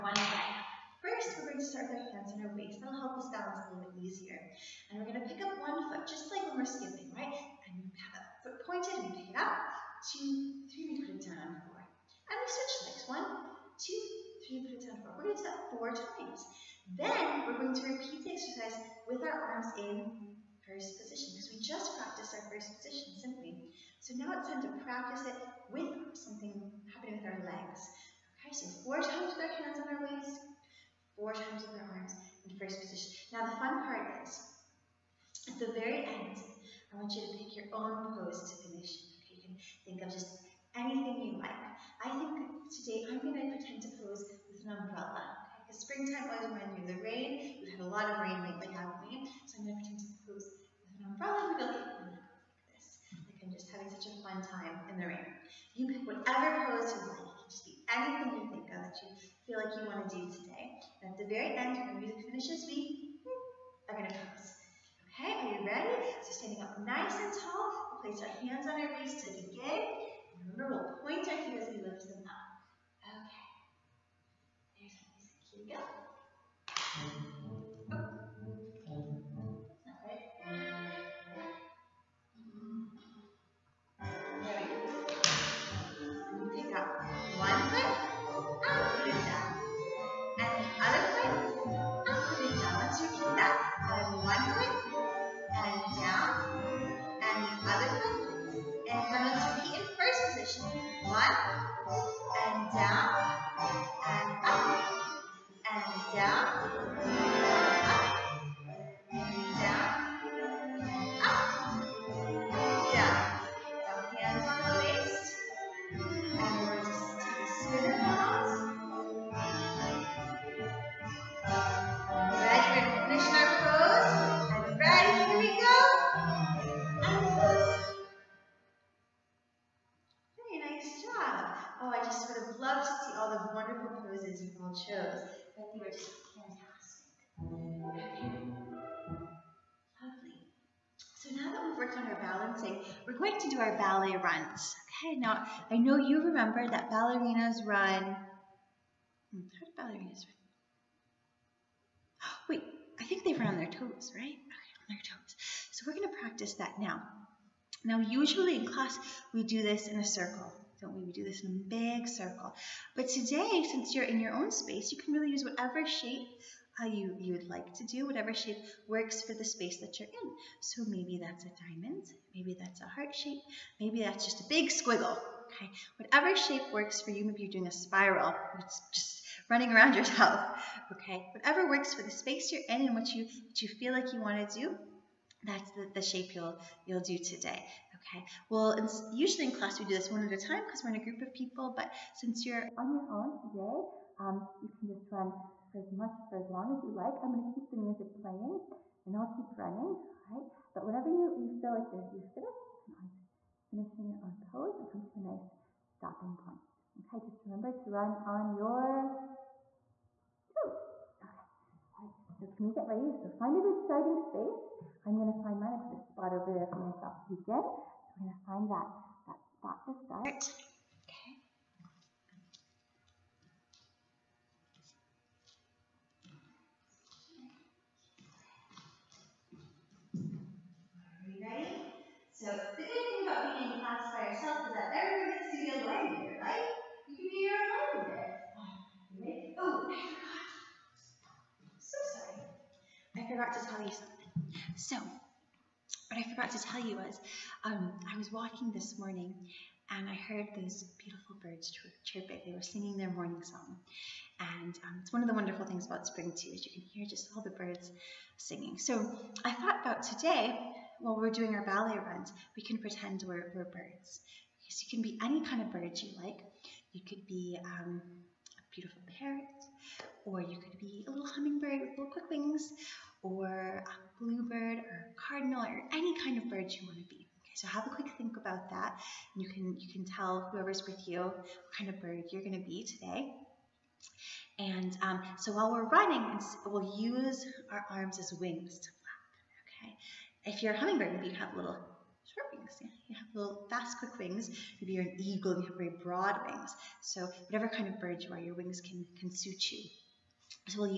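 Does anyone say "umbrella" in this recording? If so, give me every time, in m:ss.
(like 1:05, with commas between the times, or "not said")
0:44, 0:51.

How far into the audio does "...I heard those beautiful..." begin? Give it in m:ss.
4:10.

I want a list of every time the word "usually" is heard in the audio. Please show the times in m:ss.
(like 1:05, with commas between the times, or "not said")
2:37, 3:09.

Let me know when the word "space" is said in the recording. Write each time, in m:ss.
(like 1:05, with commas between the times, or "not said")
2:44, 2:49, 3:02, 3:34.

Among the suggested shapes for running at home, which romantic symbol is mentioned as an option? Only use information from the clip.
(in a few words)
Heart shape.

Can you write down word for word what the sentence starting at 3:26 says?
Okay, just remember to run on your toes.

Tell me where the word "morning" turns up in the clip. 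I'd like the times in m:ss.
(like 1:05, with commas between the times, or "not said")
4:08, 4:13.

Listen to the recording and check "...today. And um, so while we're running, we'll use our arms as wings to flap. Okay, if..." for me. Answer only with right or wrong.
right.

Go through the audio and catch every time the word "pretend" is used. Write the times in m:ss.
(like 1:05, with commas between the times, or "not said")
0:43, 0:49, 4:22.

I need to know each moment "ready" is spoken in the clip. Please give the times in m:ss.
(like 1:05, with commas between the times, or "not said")
1:05, 3:32, 3:51.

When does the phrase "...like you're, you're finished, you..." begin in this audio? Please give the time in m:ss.
3:21.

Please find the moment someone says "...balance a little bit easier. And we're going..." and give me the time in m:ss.
0:03.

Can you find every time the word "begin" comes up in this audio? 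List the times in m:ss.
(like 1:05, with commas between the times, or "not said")
1:09, 3:37.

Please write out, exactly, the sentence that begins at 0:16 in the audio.
Then we're going to repeat the exercise with our arms in first position because we just practiced our first position simply.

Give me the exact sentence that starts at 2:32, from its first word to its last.
Wait, I think they run on their toes, right?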